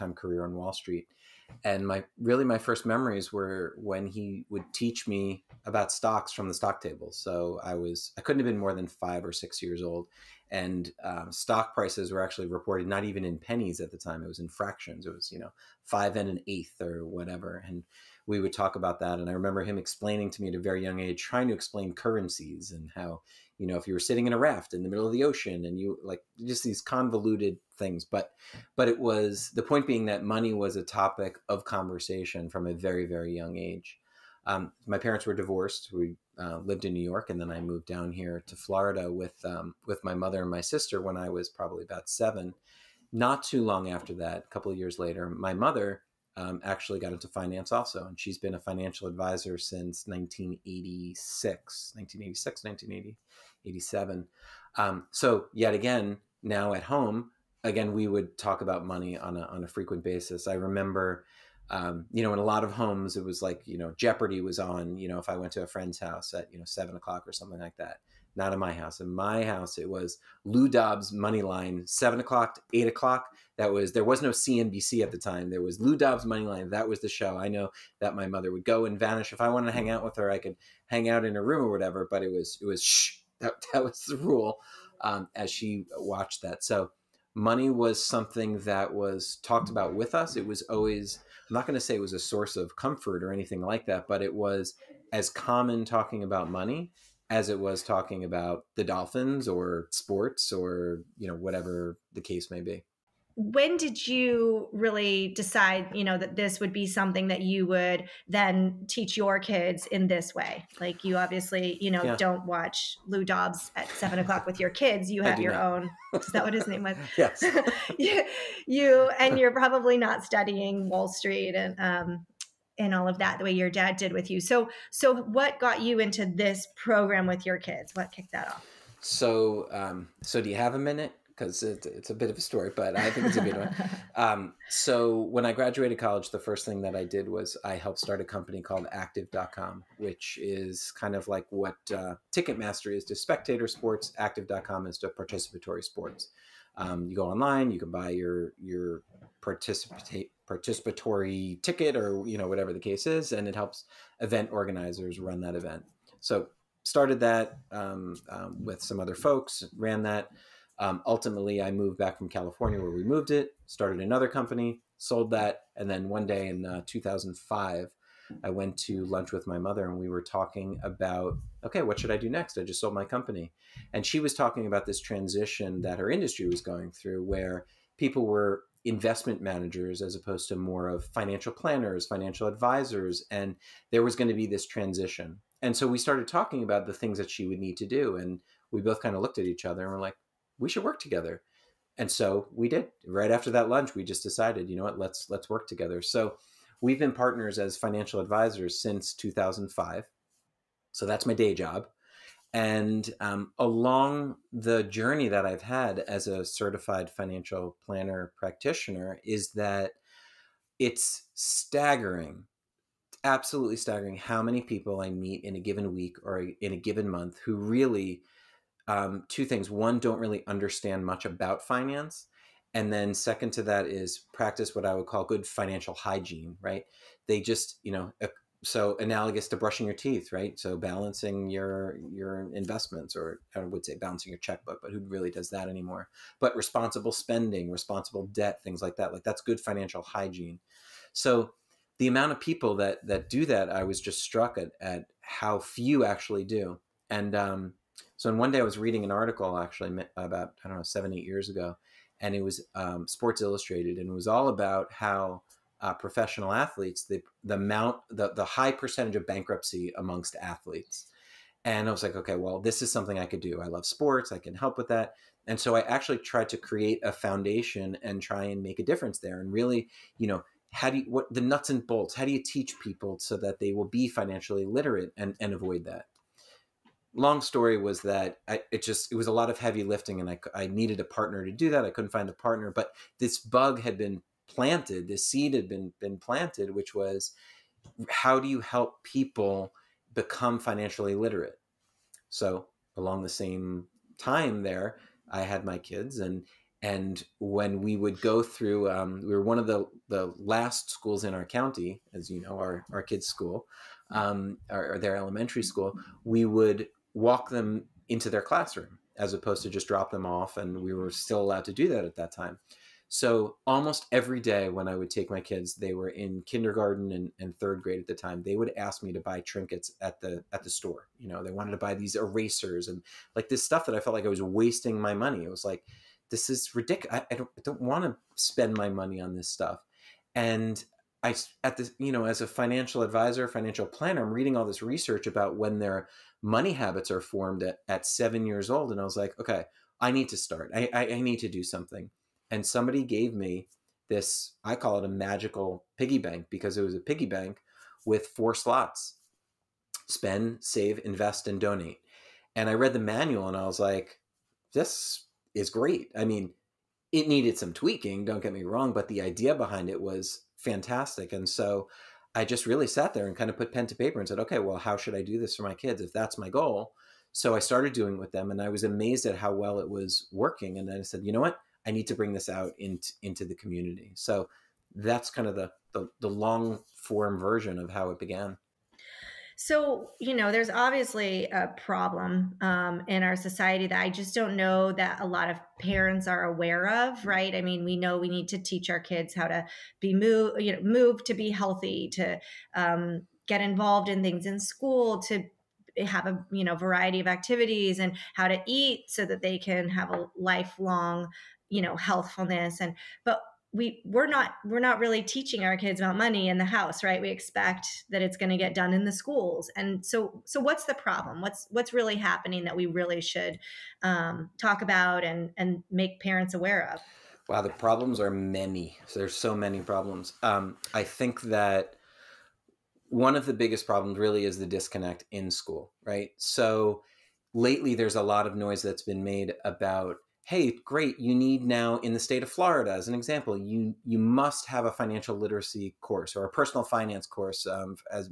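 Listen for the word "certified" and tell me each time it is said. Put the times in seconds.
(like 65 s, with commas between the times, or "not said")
206 s.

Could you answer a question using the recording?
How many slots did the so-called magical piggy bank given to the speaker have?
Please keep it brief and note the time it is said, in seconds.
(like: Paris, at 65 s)
4, at 348 s.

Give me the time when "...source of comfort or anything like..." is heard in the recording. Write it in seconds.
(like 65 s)
92 s.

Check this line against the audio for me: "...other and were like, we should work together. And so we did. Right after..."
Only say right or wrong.
right.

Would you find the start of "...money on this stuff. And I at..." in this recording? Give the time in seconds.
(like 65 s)
328 s.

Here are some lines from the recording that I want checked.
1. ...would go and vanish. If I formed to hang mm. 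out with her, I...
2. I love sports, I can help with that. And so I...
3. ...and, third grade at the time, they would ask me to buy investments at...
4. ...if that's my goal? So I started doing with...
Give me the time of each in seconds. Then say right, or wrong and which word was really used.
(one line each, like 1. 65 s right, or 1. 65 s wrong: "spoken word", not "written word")
1. 78 s wrong: "wanted", not "formed"
2. 263 s right
3. 317 s wrong: "trinkets", not "investments"
4. 366 s right.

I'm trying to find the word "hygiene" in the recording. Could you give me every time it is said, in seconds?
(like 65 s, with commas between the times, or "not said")
225 s, 240 s.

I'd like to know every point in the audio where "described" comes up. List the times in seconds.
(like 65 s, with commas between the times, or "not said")
not said.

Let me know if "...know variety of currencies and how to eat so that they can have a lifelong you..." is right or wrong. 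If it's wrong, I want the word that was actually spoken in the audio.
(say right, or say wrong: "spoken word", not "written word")
wrong: "activities", not "currencies".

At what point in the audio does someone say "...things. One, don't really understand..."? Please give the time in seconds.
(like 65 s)
219 s.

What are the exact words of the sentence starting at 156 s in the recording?
So started that um, um, with some other folks, ran that.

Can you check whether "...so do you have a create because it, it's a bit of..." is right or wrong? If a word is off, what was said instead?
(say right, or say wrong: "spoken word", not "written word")
wrong: "minute", not "create".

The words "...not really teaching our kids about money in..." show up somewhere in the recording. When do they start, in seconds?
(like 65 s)
404 s.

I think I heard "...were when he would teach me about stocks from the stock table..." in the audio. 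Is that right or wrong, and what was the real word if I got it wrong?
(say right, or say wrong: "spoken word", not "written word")
right.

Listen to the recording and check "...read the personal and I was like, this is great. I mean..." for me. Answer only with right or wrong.
wrong.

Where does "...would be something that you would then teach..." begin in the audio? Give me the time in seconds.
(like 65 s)
106 s.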